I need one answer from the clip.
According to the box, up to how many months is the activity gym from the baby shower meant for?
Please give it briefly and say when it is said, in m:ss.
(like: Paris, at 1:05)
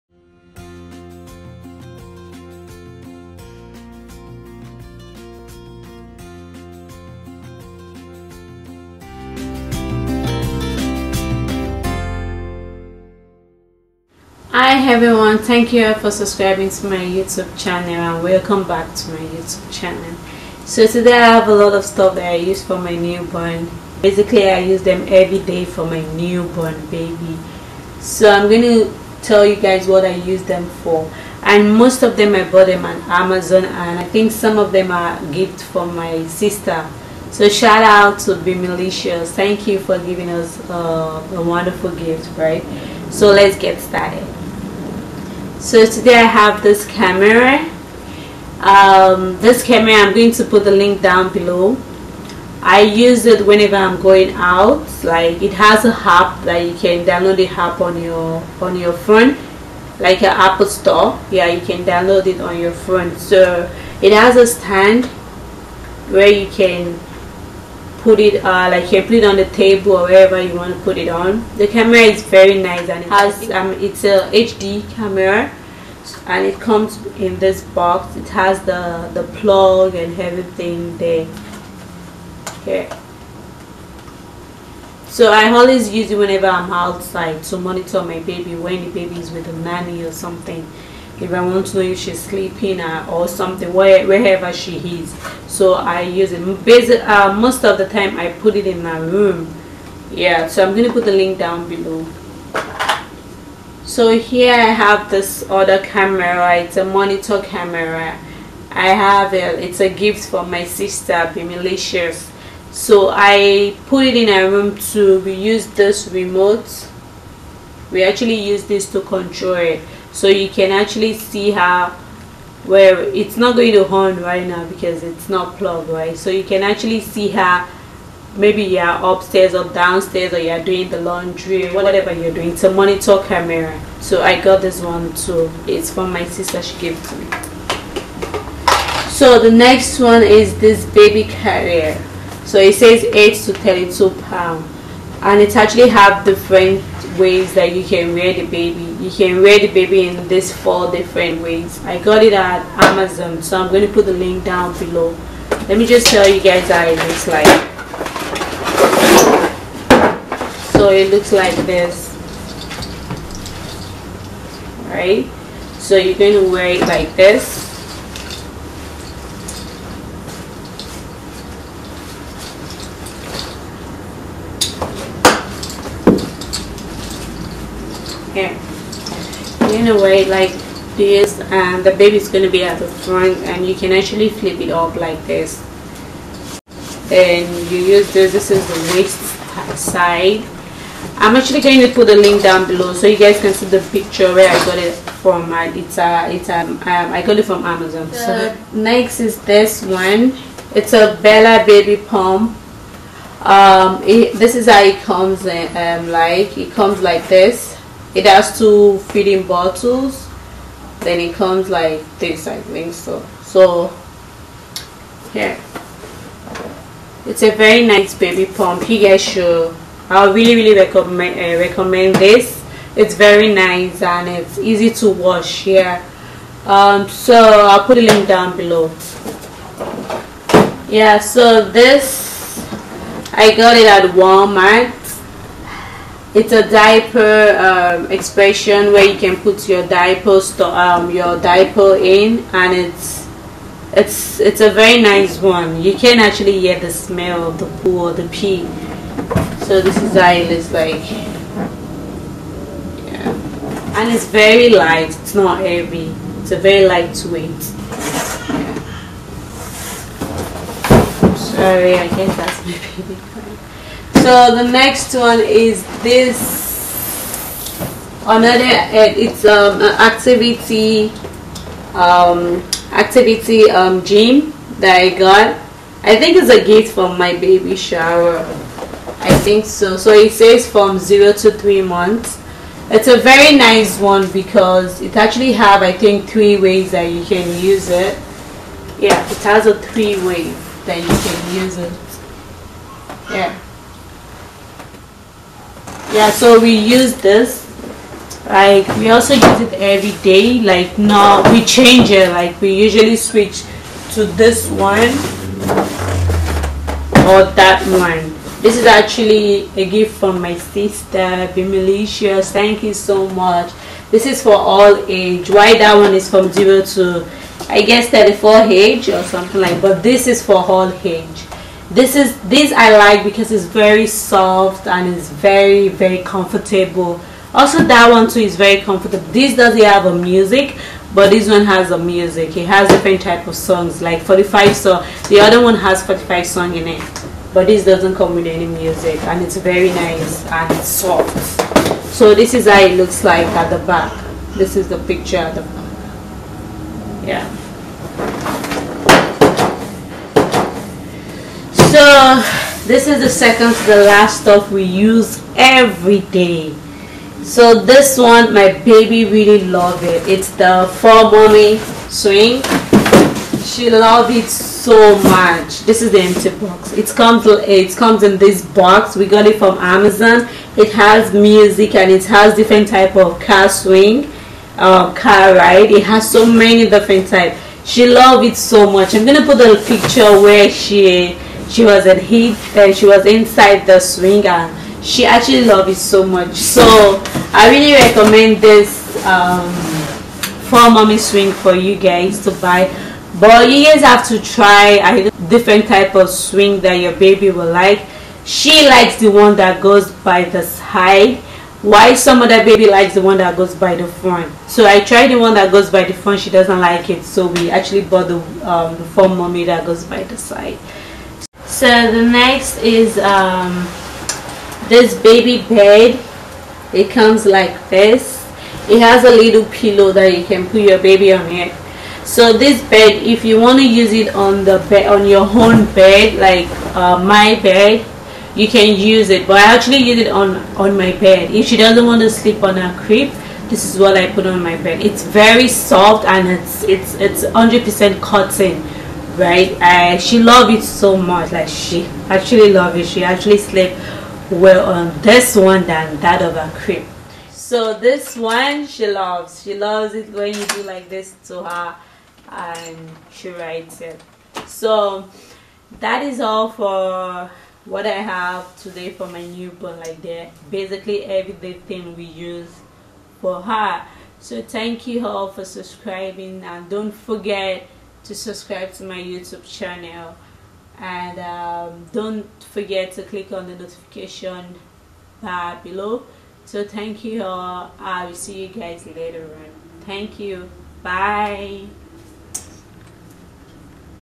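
3 months, at 4:40.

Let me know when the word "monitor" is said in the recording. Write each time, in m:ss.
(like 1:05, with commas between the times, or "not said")
1:27, 1:46, 2:12.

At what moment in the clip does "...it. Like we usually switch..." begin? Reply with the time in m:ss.
5:02.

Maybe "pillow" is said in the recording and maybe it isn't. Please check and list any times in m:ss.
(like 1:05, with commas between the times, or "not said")
6:59.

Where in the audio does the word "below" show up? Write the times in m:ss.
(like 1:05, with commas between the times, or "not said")
0:51, 1:41, 2:34, 3:12, 3:48, 7:55.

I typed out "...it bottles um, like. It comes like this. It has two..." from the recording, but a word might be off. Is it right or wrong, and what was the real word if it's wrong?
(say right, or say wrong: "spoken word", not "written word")
wrong: "comes", not "bottles".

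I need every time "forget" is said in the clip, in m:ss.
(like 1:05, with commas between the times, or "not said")
7:47, 7:52.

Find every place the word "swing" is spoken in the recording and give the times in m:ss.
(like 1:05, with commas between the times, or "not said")
6:02, 6:13, 6:23, 6:31, 6:36.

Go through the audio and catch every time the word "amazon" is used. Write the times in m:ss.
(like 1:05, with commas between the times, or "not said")
0:33, 2:32, 3:17, 6:09.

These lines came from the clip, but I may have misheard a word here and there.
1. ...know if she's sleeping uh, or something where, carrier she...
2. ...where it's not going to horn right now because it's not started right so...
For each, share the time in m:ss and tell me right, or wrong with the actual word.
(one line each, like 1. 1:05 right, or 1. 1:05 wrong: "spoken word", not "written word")
1. 1:31 wrong: "wherever", not "carrier"
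2. 2:02 wrong: "plugged", not "started".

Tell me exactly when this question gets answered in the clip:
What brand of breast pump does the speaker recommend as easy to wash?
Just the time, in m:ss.
3:21.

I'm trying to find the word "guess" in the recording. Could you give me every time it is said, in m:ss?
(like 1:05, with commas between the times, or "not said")
4:22, 5:17.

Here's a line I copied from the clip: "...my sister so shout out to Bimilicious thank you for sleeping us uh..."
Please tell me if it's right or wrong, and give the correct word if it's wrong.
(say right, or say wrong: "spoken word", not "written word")
wrong: "giving", not "sleeping".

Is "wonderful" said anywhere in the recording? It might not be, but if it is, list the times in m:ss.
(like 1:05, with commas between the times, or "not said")
0:41.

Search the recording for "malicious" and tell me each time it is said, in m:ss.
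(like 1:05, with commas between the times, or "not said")
1:51.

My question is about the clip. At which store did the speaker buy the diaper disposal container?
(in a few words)
Walmart.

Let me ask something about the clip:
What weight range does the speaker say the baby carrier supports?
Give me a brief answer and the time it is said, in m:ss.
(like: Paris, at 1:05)
8 to 32 pounds, at 2:23.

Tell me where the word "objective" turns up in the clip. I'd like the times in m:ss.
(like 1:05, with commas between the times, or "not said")
not said.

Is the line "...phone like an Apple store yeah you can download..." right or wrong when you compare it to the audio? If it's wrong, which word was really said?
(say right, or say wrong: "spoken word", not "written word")
right.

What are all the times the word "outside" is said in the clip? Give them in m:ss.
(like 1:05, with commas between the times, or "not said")
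1:26.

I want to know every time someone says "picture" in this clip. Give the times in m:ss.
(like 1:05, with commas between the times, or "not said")
3:13, 5:44, 6:19.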